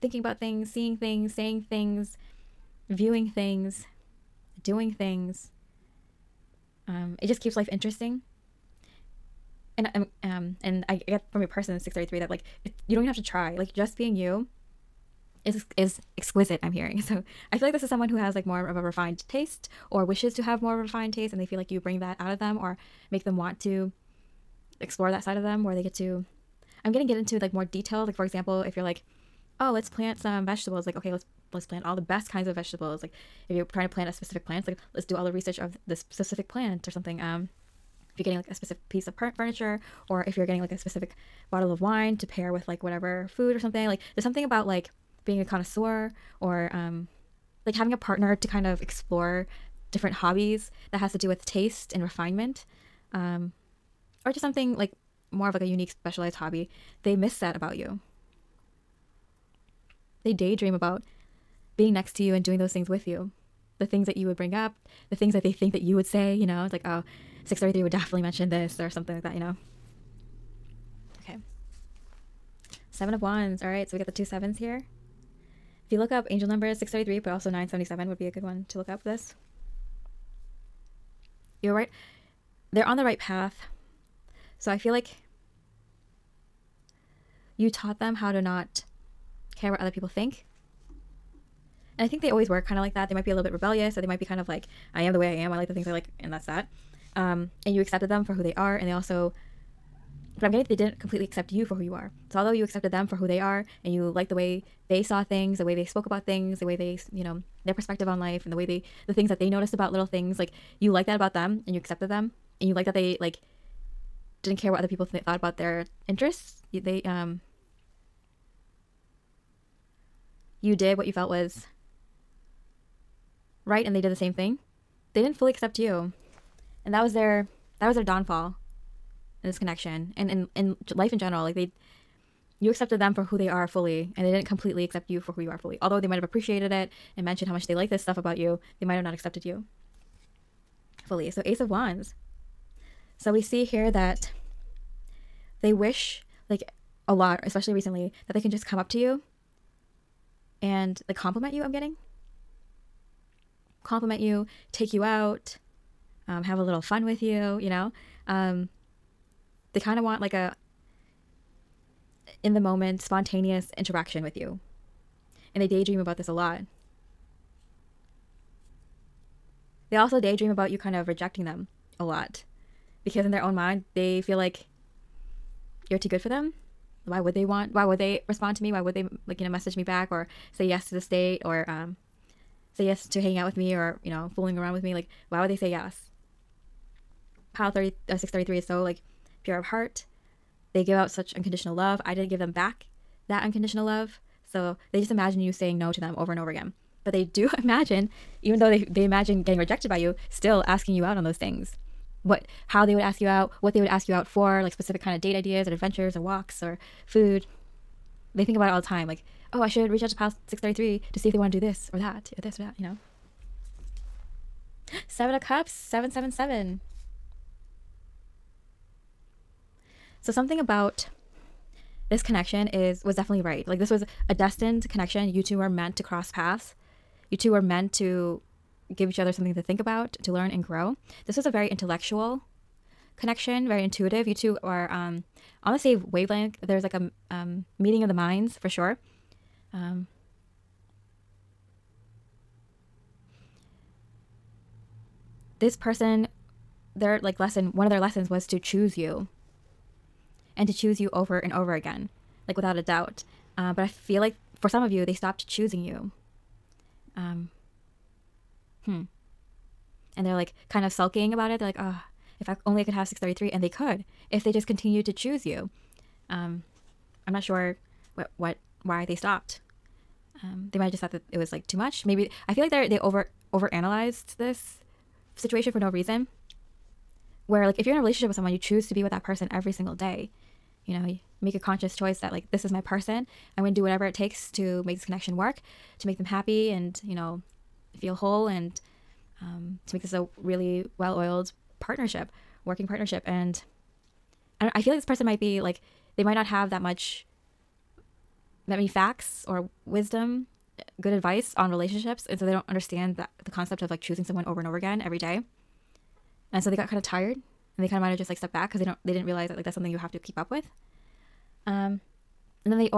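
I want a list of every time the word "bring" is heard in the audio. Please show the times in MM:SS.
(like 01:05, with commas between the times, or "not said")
00:21, 01:04.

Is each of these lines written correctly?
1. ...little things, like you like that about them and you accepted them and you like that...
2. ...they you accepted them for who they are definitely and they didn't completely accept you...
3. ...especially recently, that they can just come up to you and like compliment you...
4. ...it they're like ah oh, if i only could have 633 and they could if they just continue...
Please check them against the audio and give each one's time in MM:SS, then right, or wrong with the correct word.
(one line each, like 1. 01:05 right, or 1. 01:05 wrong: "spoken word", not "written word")
1. 01:49 right
2. 02:11 wrong: "fully", not "definitely"
3. 02:27 right
4. 04:21 right.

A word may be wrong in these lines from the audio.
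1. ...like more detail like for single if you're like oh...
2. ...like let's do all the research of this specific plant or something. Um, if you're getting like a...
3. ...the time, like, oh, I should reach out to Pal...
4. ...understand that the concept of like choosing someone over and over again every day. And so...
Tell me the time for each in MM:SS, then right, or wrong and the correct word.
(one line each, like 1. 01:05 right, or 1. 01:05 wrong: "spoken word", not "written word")
1. 00:27 wrong: "example", not "single"
2. 00:34 right
3. 03:28 right
4. 05:02 right.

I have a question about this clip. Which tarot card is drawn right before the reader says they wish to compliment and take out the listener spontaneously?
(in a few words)
Ace of Wands.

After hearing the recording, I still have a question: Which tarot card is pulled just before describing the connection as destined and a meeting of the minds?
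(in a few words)
Seven of Cups.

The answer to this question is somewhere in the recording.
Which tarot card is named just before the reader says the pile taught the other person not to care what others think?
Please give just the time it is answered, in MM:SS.
01:12.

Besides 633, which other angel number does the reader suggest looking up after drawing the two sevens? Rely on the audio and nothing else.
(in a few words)
977.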